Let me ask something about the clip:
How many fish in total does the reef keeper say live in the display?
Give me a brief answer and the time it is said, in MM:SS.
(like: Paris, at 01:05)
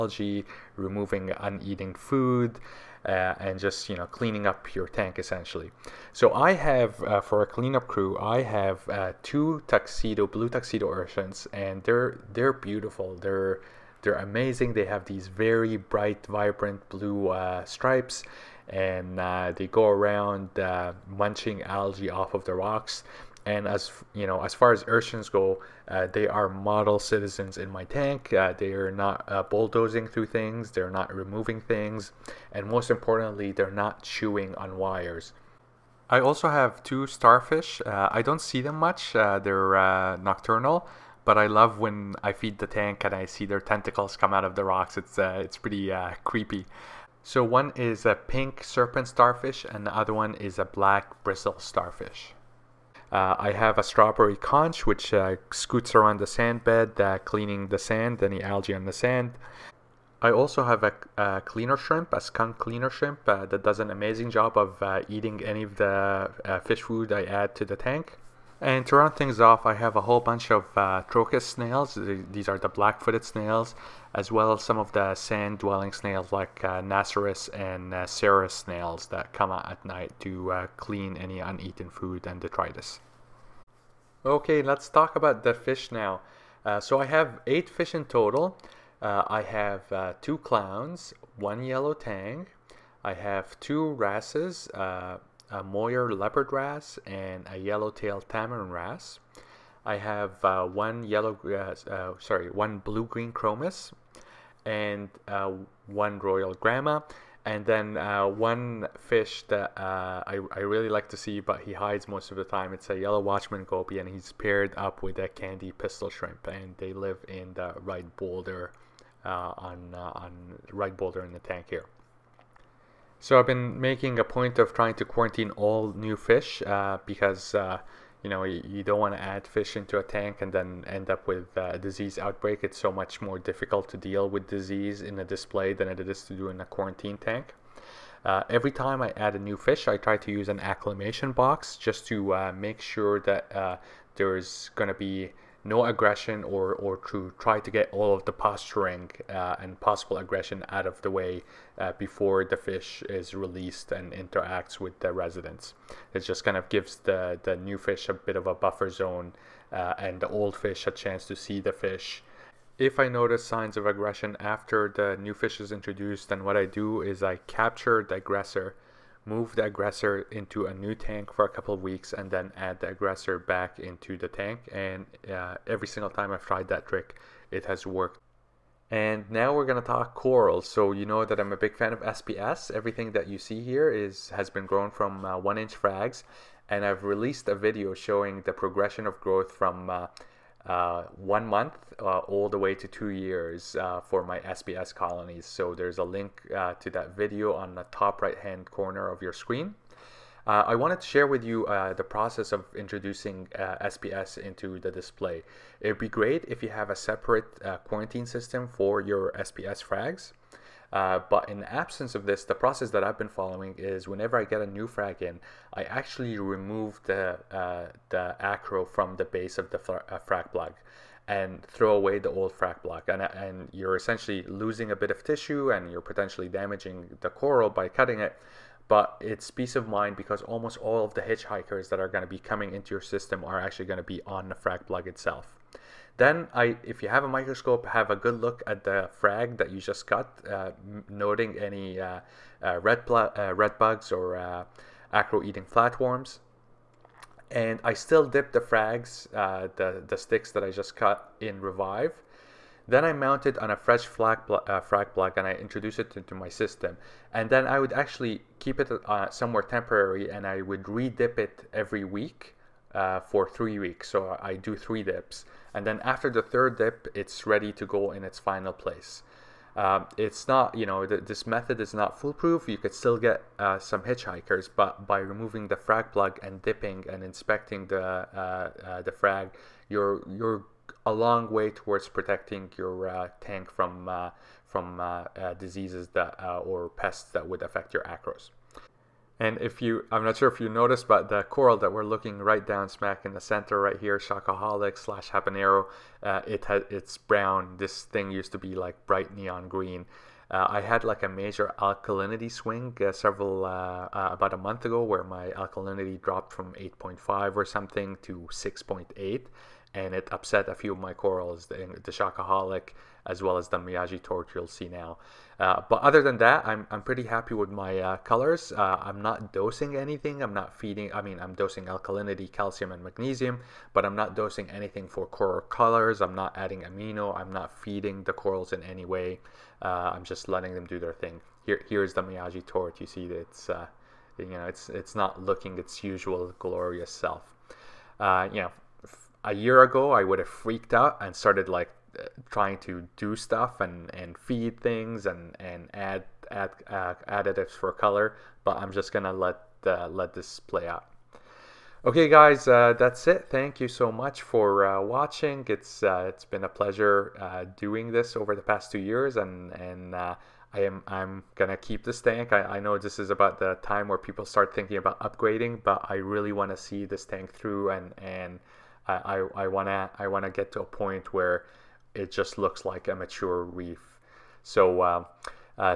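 8, at 01:27.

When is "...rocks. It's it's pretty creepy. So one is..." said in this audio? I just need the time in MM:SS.
00:44.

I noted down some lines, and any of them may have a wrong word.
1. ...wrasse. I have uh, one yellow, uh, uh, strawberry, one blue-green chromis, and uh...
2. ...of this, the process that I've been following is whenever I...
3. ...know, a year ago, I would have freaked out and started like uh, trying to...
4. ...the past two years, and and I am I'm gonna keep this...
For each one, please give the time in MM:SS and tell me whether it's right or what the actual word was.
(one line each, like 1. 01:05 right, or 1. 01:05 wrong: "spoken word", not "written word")
1. 01:38 wrong: "sorry", not "strawberry"
2. 03:32 right
3. 05:38 right
4. 05:58 right.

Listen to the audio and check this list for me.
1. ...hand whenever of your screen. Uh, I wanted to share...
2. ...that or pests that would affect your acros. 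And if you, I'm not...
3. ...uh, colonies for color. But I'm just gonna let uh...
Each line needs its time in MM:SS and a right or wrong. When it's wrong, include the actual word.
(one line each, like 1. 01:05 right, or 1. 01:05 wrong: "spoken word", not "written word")
1. 03:18 wrong: "corner", not "whenever"
2. 04:46 right
3. 05:46 wrong: "additives", not "colonies".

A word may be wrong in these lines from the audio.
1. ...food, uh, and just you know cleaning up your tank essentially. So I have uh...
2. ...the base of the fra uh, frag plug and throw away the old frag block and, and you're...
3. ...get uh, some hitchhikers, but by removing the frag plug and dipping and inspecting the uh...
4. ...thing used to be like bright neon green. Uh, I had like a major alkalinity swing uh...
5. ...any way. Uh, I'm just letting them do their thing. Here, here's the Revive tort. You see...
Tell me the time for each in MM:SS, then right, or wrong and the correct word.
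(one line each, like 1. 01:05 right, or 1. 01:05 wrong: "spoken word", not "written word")
1. 00:01 right
2. 03:39 right
3. 04:33 right
4. 04:58 right
5. 05:28 wrong: "Miyagi", not "Revive".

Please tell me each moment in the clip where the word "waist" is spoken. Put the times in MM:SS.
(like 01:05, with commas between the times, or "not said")
not said.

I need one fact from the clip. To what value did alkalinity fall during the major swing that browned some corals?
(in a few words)
6.8.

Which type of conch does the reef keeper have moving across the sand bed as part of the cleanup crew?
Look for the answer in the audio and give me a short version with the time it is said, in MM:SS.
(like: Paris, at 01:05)
Strawberry conch, at 00:53.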